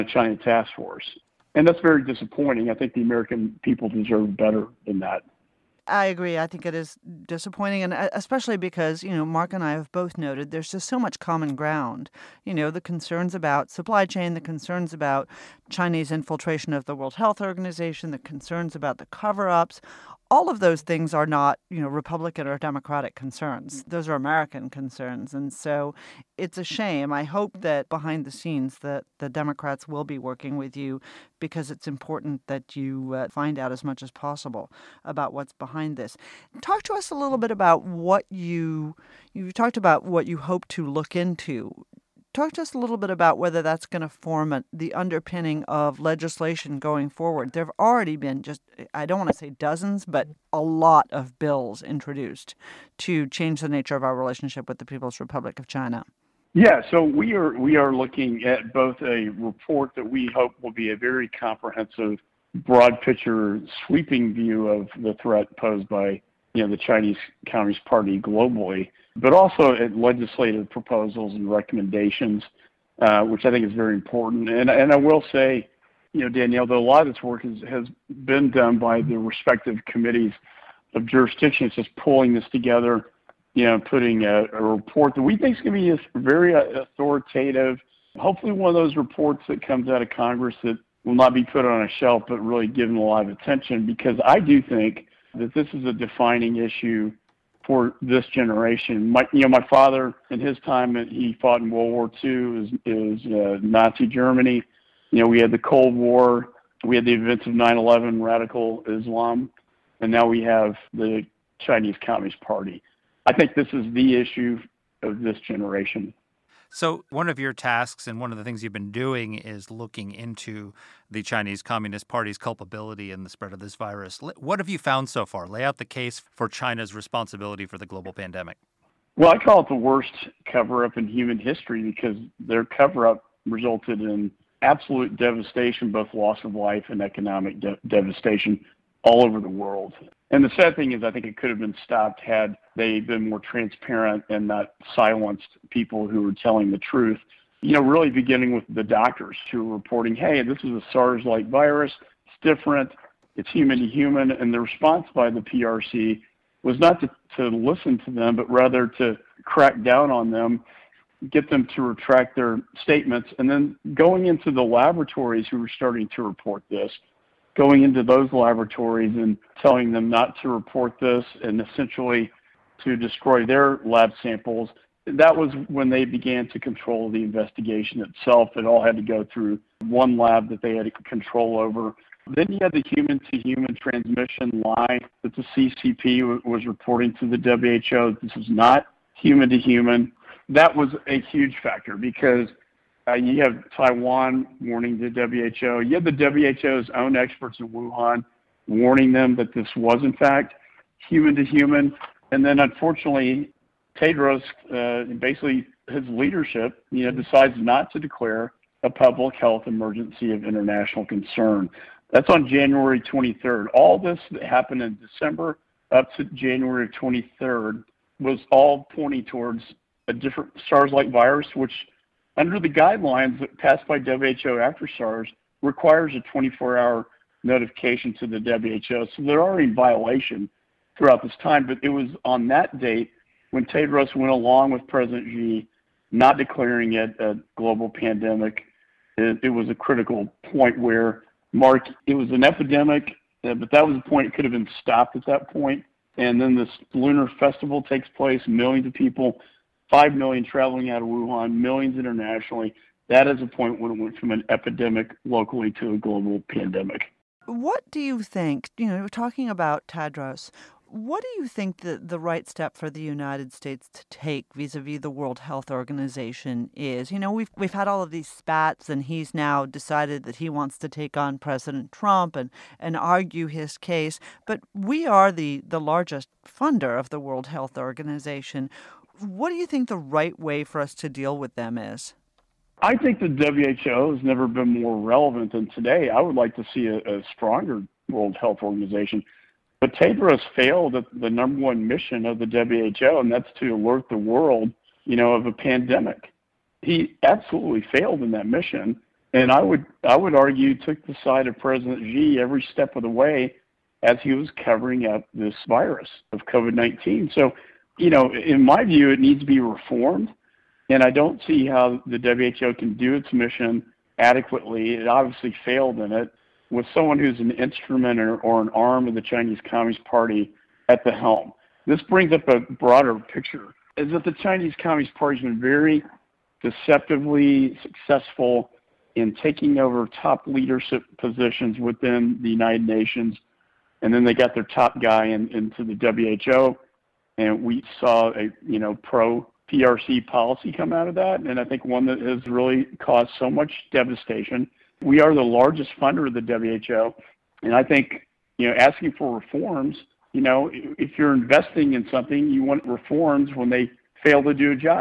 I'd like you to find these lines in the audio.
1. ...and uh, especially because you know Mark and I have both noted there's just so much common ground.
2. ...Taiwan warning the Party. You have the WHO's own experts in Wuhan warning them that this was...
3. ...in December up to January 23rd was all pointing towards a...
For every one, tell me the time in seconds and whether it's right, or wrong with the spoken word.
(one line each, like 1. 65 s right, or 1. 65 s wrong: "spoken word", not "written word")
1. 7 s right
2. 193 s wrong: "WHO", not "Party"
3. 214 s right.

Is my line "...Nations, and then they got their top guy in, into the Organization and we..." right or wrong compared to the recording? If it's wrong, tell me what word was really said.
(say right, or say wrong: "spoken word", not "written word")
wrong: "WHO", not "Organization".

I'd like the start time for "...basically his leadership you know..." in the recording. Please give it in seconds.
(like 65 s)
205 s.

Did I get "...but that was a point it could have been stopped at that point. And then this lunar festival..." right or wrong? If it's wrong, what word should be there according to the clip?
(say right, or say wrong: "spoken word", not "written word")
right.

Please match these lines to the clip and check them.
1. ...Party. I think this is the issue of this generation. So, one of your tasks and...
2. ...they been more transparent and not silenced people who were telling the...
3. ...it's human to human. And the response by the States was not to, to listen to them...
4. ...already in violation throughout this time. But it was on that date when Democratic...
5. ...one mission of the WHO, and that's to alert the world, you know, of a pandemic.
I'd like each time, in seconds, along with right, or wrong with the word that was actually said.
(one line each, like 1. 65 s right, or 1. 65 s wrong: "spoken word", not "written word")
1. 112 s right
2. 142 s right
3. 153 s wrong: "PRC", not "States"
4. 229 s wrong: "Tedros", not "Democratic"
5. 291 s right.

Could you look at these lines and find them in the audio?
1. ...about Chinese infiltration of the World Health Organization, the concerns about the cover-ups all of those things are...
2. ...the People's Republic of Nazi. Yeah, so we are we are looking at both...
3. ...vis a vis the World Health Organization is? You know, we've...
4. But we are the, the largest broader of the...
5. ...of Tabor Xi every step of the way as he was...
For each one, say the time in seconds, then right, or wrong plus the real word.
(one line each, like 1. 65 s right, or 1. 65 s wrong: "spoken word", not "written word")
1. 14 s right
2. 54 s wrong: "China", not "Nazi"
3. 264 s right
4. 274 s wrong: "funder", not "broader"
5. 301 s wrong: "President", not "Tabor".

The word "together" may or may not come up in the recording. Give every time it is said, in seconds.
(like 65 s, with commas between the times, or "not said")
82 s.